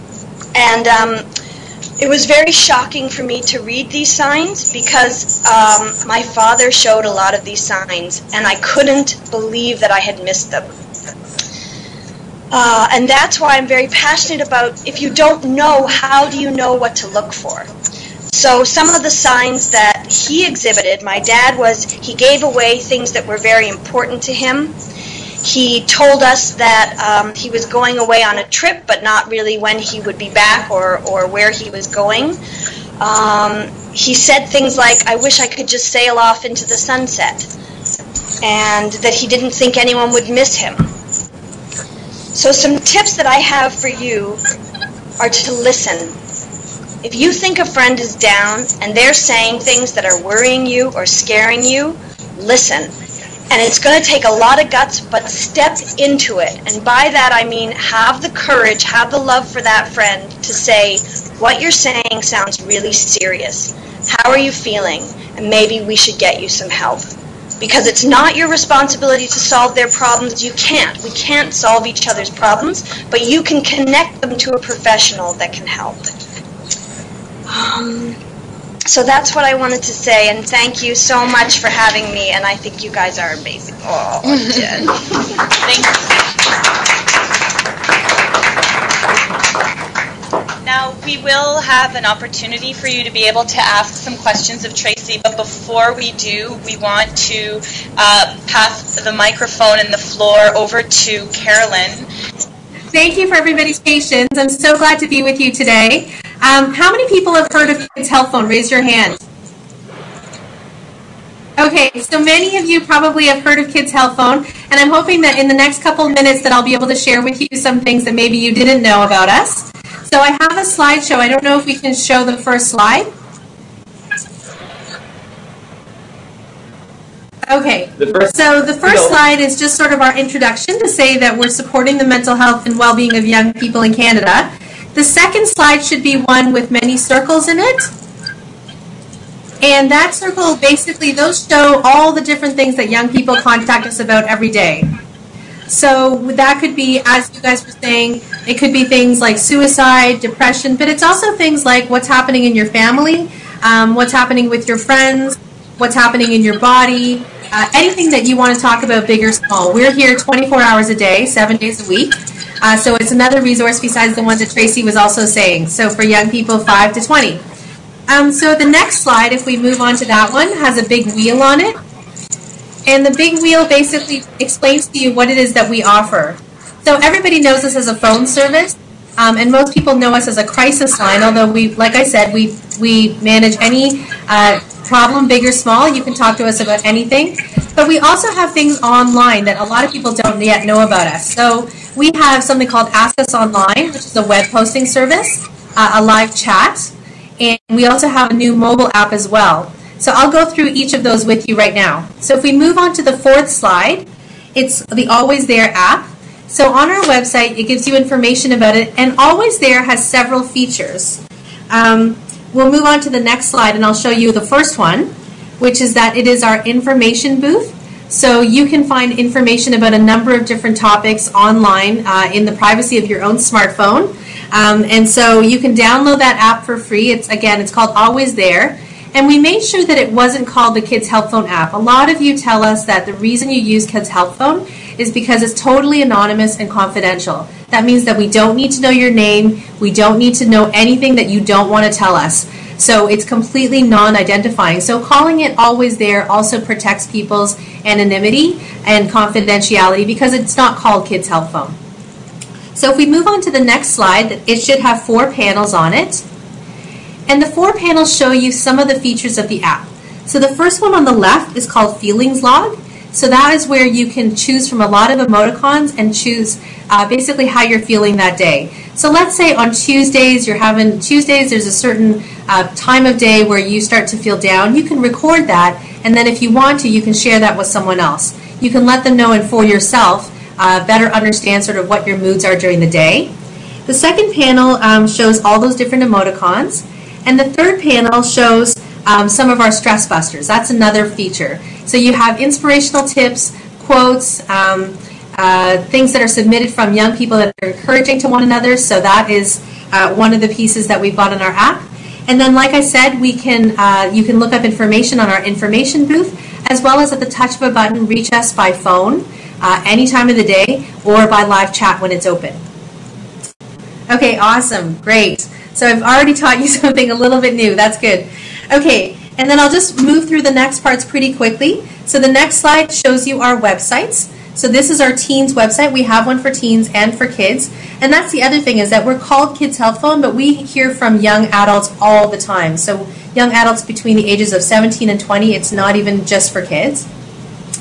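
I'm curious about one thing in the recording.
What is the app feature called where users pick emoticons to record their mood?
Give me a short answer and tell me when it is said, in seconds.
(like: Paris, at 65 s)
Feelings Log, at 261 s.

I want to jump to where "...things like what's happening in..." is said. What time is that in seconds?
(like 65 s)
151 s.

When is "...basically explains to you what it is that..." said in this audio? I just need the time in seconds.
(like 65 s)
173 s.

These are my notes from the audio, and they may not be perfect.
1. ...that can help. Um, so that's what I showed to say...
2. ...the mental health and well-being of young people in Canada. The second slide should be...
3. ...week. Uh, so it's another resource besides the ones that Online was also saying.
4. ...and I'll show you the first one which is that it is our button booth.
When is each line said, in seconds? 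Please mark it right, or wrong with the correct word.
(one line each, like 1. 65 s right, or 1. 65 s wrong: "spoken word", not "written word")
1. 75 s wrong: "wanted", not "showed"
2. 131 s right
3. 161 s wrong: "Tracy", not "Online"
4. 213 s wrong: "information", not "button".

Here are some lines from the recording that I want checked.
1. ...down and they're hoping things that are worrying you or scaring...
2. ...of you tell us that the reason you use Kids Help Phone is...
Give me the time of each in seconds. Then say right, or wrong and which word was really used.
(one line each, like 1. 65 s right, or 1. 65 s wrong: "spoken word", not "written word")
1. 48 s wrong: "saying", not "hoping"
2. 232 s right.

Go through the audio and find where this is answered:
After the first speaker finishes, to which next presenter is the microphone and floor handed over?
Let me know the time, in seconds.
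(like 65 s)
101 s.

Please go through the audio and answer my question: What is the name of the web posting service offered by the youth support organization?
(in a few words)
Ask Us Online.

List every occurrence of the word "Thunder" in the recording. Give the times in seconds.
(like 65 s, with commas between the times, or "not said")
not said.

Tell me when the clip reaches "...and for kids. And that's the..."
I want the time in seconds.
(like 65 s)
326 s.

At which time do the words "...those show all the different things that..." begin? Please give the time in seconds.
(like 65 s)
141 s.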